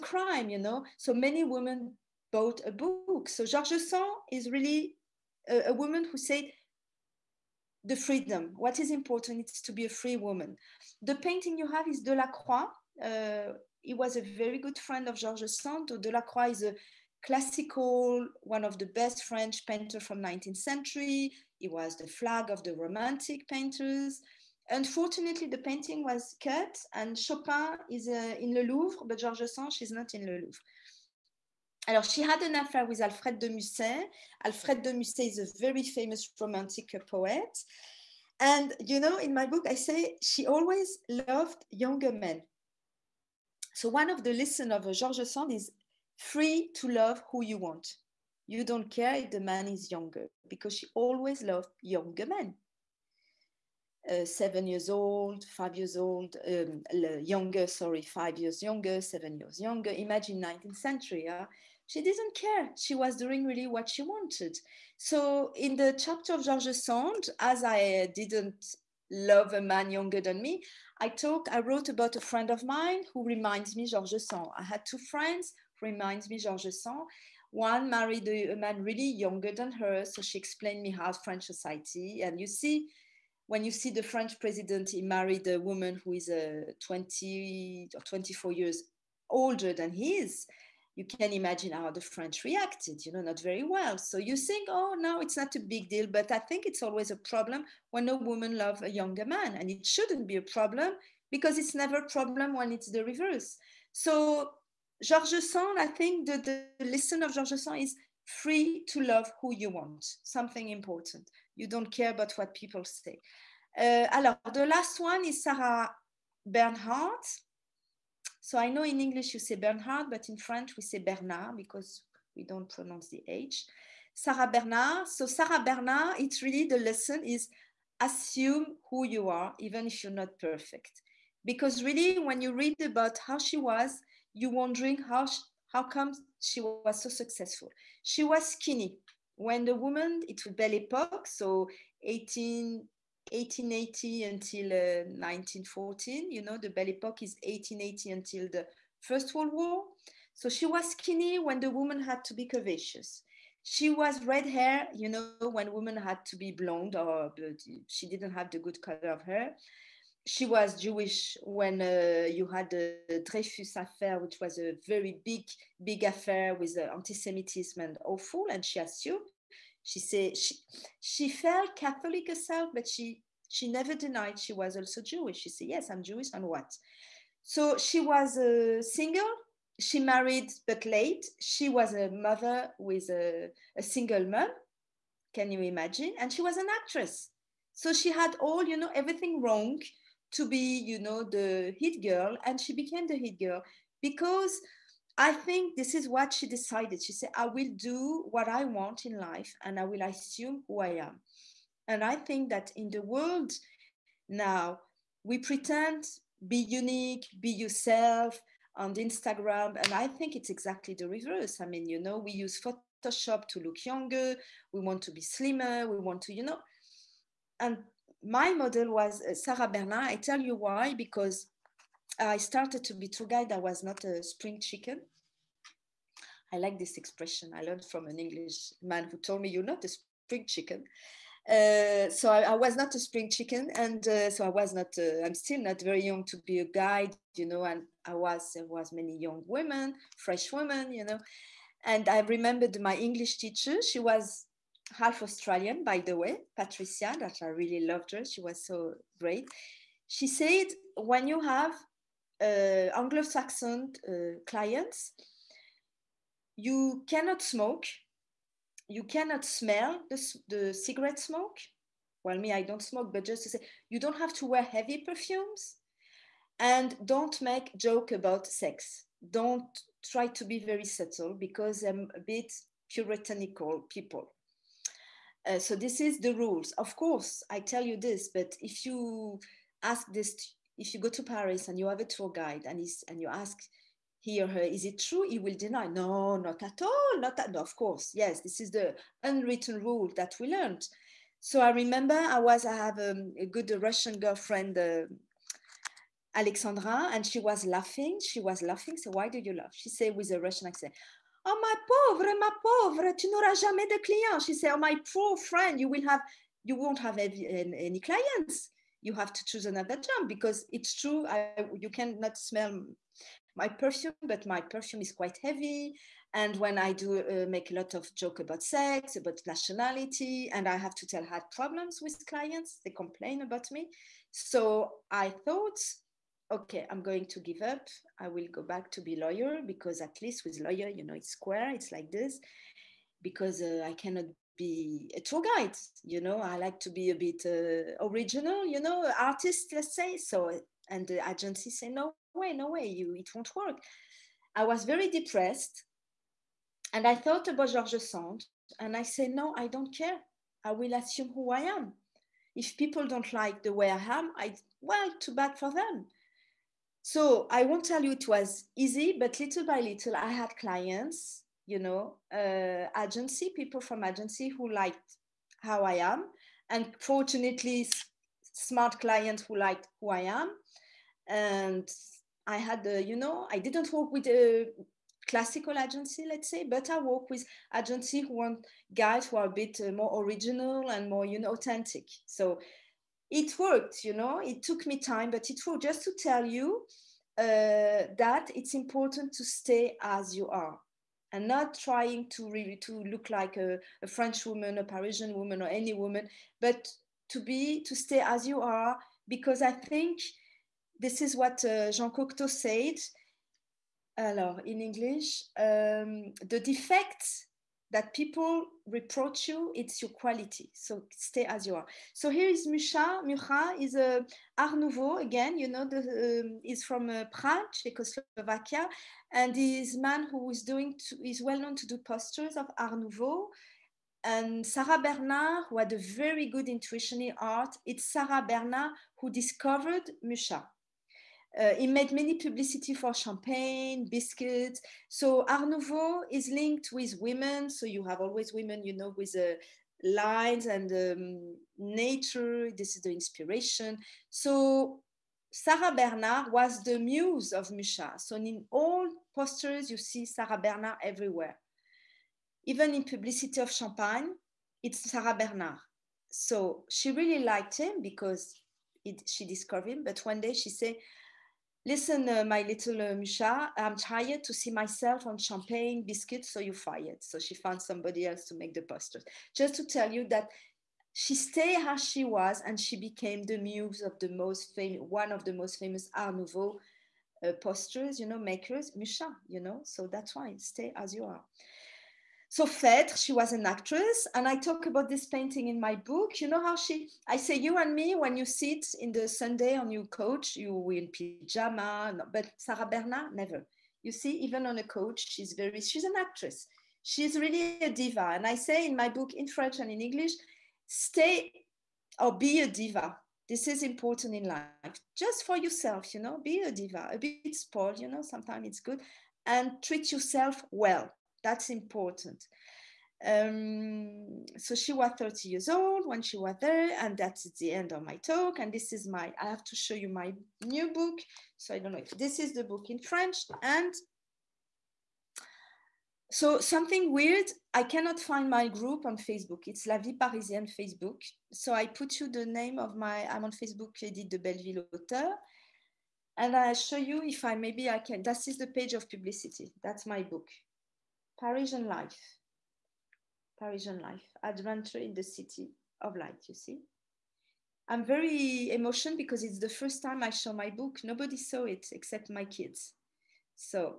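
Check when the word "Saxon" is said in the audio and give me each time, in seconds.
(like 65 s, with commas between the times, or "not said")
252 s.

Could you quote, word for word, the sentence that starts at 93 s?
So you think, oh, no, it's not a big deal.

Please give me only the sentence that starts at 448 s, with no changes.
So in all posters, you see Sarah Bernard everywhere.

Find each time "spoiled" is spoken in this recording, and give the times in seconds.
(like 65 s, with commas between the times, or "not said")
507 s.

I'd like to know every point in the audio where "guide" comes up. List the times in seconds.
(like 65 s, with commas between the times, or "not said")
223 s, 236 s, 282 s, 335 s.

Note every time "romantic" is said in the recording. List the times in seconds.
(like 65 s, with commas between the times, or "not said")
22 s, 36 s.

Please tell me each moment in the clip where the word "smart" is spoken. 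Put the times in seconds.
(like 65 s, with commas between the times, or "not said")
368 s.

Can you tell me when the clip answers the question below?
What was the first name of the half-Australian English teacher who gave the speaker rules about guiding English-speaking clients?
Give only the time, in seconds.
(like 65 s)
246 s.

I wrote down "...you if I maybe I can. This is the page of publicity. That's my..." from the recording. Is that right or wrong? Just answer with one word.
right.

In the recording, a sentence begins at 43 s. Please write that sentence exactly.
So, one of the lessons of George Sand is free to love who you want.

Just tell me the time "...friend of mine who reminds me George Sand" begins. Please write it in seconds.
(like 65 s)
72 s.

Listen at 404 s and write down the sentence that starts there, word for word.
Alors, in English, um, the defects that people reproach you, it's your quality.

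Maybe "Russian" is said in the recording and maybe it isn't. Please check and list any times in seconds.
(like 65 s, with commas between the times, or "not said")
293 s, 300 s.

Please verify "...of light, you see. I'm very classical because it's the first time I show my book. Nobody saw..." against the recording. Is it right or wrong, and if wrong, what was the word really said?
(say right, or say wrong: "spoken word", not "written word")
wrong: "emotional", not "classical".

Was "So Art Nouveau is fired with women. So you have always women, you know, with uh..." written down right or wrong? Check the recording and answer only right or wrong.
wrong.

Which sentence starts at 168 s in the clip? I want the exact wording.
And she assumed, she said, she, she felt Catholic herself, but she she never denied she was also Jewish.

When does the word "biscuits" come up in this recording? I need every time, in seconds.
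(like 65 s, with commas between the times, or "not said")
434 s, 466 s.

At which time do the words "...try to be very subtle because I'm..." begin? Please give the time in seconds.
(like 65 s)
270 s.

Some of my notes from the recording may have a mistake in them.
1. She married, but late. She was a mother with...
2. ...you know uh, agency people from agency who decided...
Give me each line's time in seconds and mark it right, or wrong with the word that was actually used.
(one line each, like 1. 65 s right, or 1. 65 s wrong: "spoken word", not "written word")
1. 179 s right
2. 361 s wrong: "liked", not "decided".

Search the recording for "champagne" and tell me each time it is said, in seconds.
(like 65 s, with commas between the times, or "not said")
433 s, 453 s, 465 s.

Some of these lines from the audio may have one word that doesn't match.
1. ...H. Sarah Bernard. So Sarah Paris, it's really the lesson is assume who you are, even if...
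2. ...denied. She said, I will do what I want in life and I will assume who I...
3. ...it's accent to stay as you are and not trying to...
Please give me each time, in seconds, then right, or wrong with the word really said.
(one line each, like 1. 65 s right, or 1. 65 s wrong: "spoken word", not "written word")
1. 123 s wrong: "Bernard", not "Paris"
2. 196 s wrong: "decided", not "denied"
3. 388 s wrong: "important", not "accent".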